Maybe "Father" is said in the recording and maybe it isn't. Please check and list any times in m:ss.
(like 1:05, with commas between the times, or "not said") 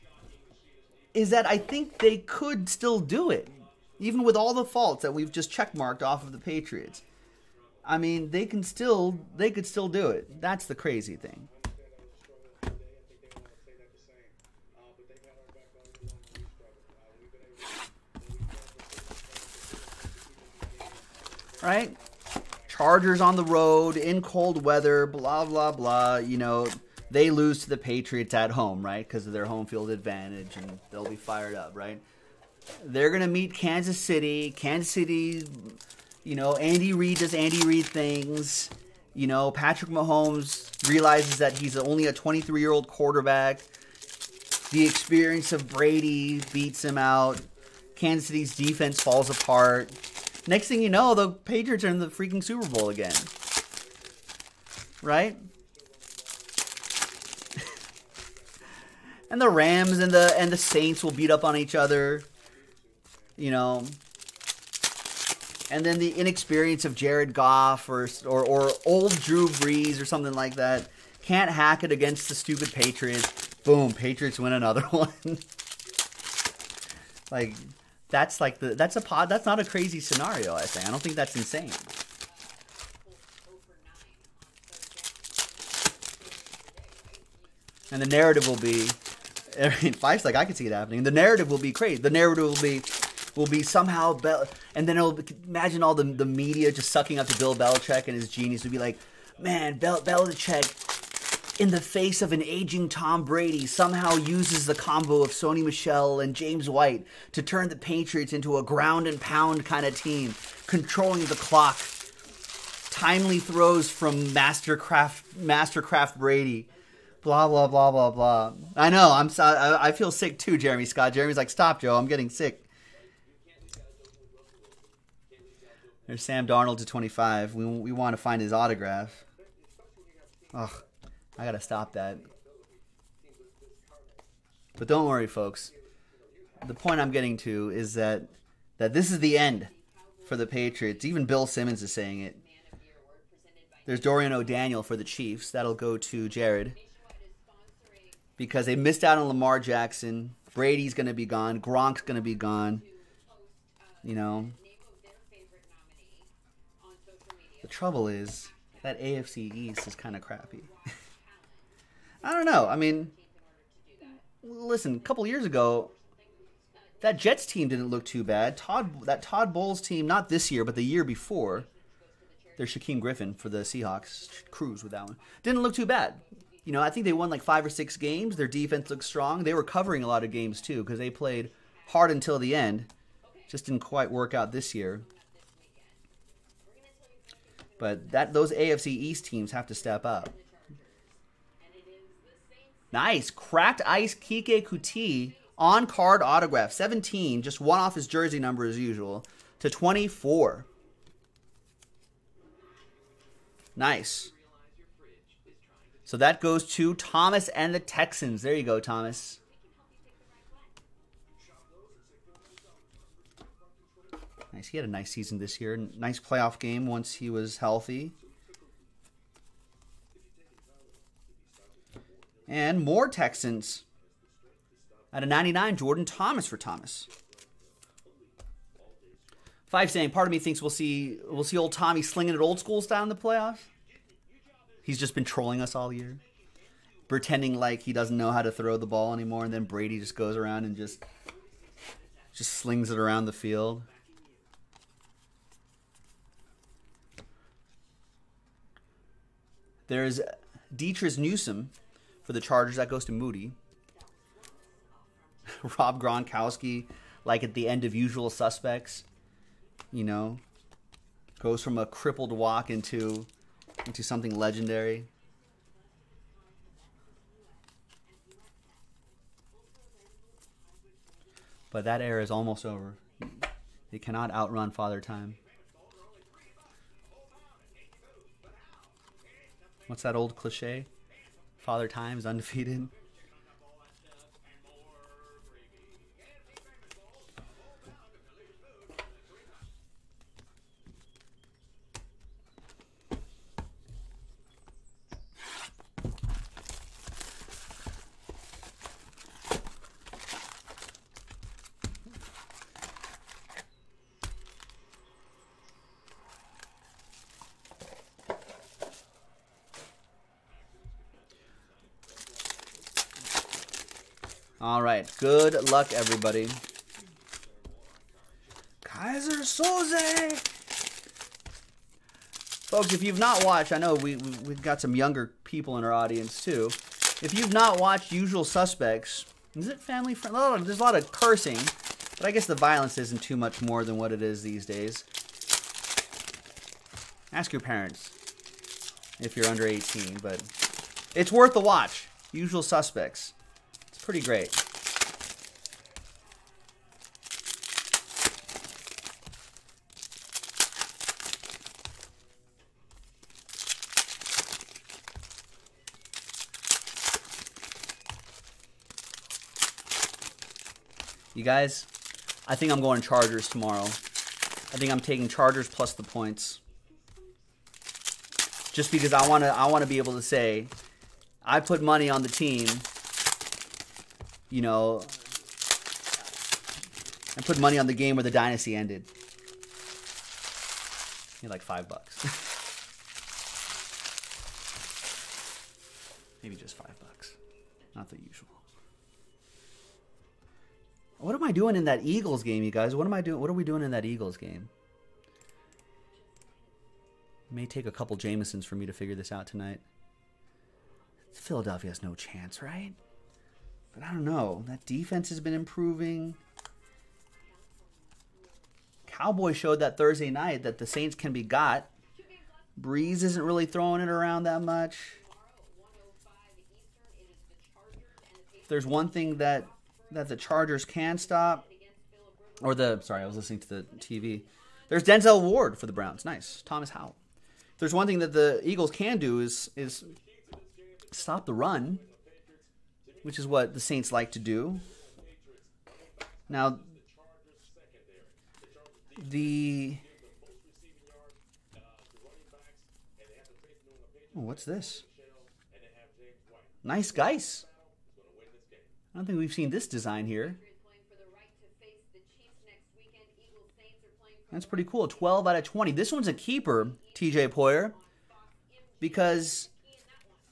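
4:34, 4:41.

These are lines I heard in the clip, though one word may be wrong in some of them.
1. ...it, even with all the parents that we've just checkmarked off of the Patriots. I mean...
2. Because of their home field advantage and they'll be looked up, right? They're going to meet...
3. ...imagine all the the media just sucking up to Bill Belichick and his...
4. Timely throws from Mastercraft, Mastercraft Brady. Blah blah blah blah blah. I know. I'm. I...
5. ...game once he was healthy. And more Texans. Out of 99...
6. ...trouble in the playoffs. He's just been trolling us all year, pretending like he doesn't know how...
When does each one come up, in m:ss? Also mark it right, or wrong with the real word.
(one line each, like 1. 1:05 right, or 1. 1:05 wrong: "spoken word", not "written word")
1. 0:03 wrong: "faults", not "parents"
2. 0:29 wrong: "fired", not "looked"
3. 1:35 right
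4. 1:52 right
5. 3:36 right
6. 3:52 wrong: "style", not "trouble".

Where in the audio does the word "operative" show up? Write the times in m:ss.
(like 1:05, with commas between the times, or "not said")
not said.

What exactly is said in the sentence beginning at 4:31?
But that era is almost over.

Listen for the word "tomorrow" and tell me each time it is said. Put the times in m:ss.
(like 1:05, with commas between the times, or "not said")
6:03.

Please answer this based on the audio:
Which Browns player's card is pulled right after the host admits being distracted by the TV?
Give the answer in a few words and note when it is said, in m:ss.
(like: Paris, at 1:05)
Denzel Ward, at 7:05.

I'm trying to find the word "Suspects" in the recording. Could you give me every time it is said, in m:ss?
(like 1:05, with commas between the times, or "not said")
4:18, 5:28, 5:42.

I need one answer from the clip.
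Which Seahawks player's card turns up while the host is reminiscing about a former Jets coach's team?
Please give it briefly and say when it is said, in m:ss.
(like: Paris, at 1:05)
Shaquem Griffin, at 2:52.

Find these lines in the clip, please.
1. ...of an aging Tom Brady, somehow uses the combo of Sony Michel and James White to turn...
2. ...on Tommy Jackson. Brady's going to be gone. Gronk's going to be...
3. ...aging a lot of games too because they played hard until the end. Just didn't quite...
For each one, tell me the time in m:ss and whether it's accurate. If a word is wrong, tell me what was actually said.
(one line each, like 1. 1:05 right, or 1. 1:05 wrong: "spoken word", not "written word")
1. 1:42 right
2. 2:29 wrong: "Lamar", not "Tommy"
3. 2:59 wrong: "covering", not "aging".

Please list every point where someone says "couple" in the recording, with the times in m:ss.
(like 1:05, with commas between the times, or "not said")
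2:44, 6:37.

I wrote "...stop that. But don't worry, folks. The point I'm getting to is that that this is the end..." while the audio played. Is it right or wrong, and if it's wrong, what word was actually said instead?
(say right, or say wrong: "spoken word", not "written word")
right.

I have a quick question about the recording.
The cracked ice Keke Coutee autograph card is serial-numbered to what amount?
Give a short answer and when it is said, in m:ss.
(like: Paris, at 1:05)
24, at 3:19.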